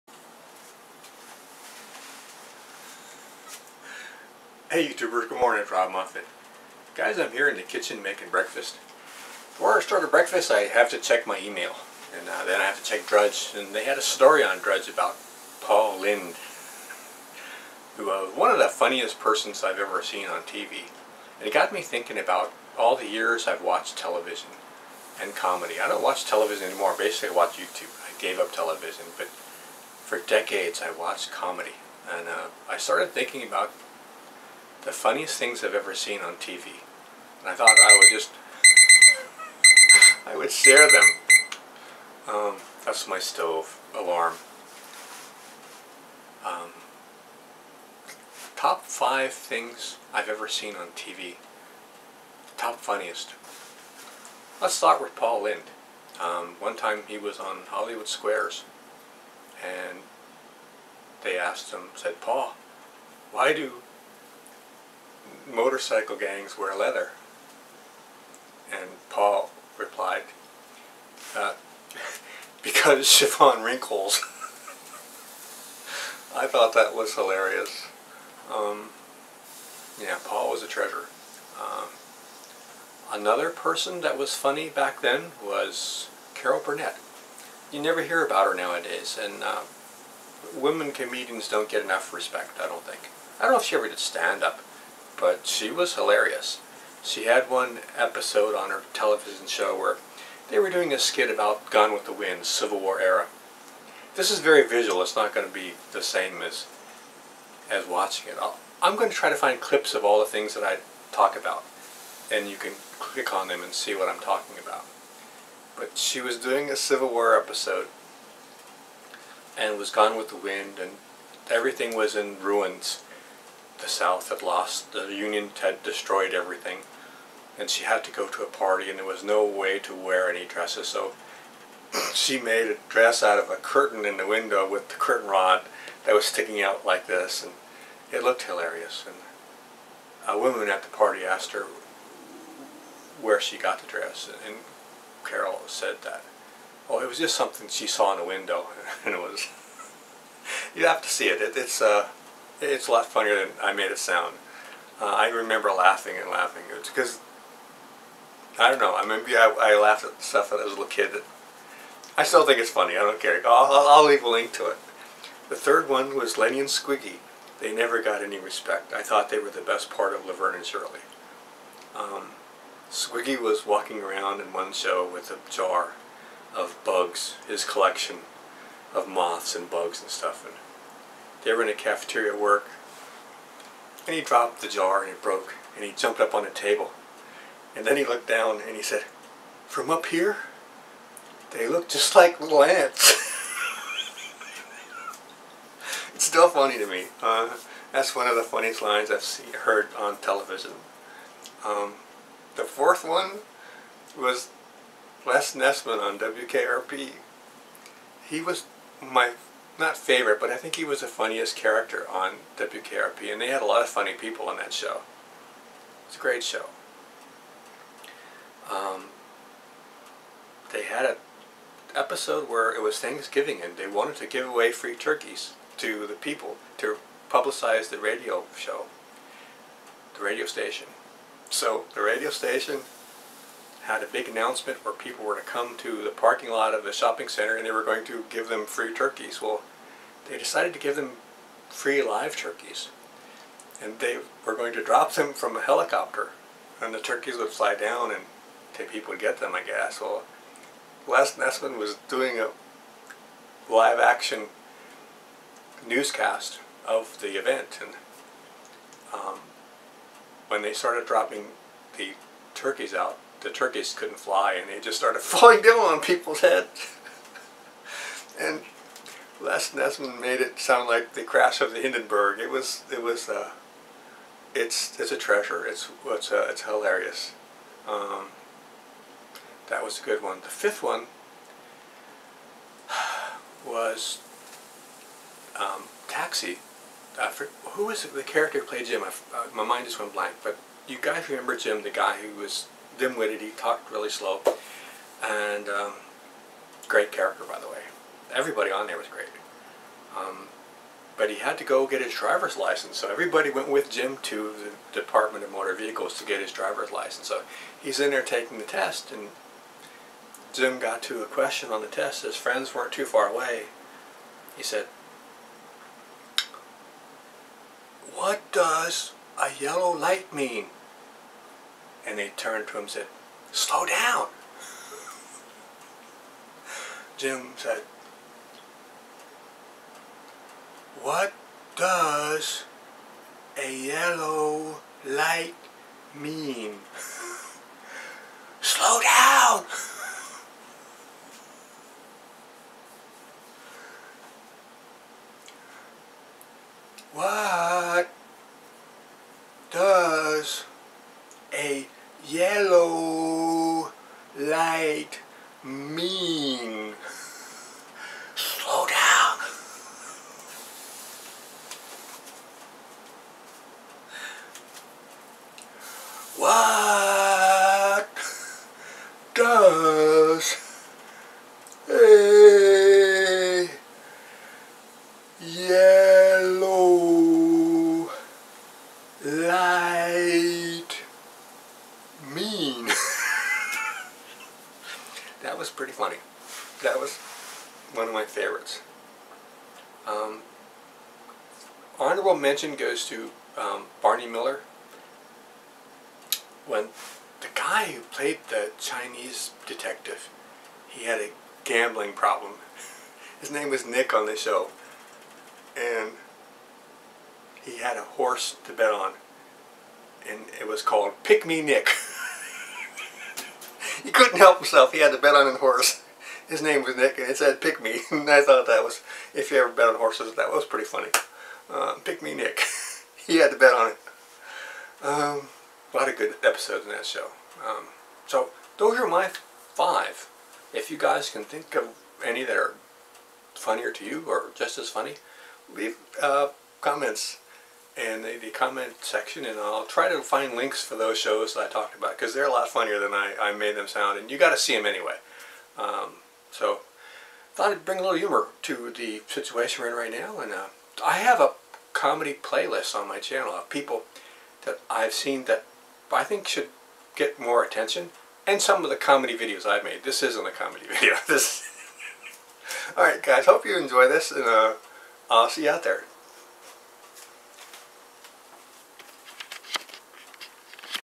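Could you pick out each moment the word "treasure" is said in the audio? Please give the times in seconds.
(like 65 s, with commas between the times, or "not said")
80 s, 275 s.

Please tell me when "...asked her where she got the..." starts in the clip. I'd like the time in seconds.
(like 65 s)
141 s.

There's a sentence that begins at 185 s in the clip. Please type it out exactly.
And he jumped up on the table.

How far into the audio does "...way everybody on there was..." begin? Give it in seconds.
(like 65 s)
297 s.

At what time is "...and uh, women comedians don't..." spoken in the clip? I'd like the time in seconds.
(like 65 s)
89 s.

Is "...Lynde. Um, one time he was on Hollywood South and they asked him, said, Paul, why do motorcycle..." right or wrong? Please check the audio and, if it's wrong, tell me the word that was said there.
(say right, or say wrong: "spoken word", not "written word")
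wrong: "Squares", not "South".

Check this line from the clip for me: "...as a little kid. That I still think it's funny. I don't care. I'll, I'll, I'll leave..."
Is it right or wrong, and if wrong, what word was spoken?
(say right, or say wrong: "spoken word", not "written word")
right.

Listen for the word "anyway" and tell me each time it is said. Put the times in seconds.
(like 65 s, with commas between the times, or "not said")
444 s.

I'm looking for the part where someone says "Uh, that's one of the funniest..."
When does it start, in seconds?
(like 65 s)
197 s.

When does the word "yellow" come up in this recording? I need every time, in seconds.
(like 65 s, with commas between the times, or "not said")
319 s, 333 s, 352 s, 375 s.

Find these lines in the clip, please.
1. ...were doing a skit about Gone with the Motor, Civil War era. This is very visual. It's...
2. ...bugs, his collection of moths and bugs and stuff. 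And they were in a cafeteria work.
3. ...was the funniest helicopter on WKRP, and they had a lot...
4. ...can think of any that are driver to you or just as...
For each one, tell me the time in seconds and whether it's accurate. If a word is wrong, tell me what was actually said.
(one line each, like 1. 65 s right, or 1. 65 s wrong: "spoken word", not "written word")
1. 100 s wrong: "Wind", not "Motor"
2. 176 s right
3. 210 s wrong: "character", not "helicopter"
4. 431 s wrong: "funnier", not "driver".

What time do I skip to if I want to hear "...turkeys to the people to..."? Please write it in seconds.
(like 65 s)
224 s.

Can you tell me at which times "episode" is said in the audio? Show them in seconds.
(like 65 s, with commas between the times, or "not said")
97 s, 117 s, 221 s, 426 s.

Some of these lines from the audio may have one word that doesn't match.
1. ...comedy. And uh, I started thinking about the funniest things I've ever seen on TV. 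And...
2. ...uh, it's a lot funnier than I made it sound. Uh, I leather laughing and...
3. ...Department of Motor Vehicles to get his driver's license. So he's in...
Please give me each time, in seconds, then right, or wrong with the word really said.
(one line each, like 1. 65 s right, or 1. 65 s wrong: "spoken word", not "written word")
1. 31 s right
2. 151 s wrong: "remember", not "leather"
3. 304 s right.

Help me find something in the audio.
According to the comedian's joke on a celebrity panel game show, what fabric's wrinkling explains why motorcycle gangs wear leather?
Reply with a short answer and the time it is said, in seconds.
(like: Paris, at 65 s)
chiffon, at 73 s.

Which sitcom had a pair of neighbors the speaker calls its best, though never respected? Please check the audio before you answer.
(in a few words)
Laverne and Shirley.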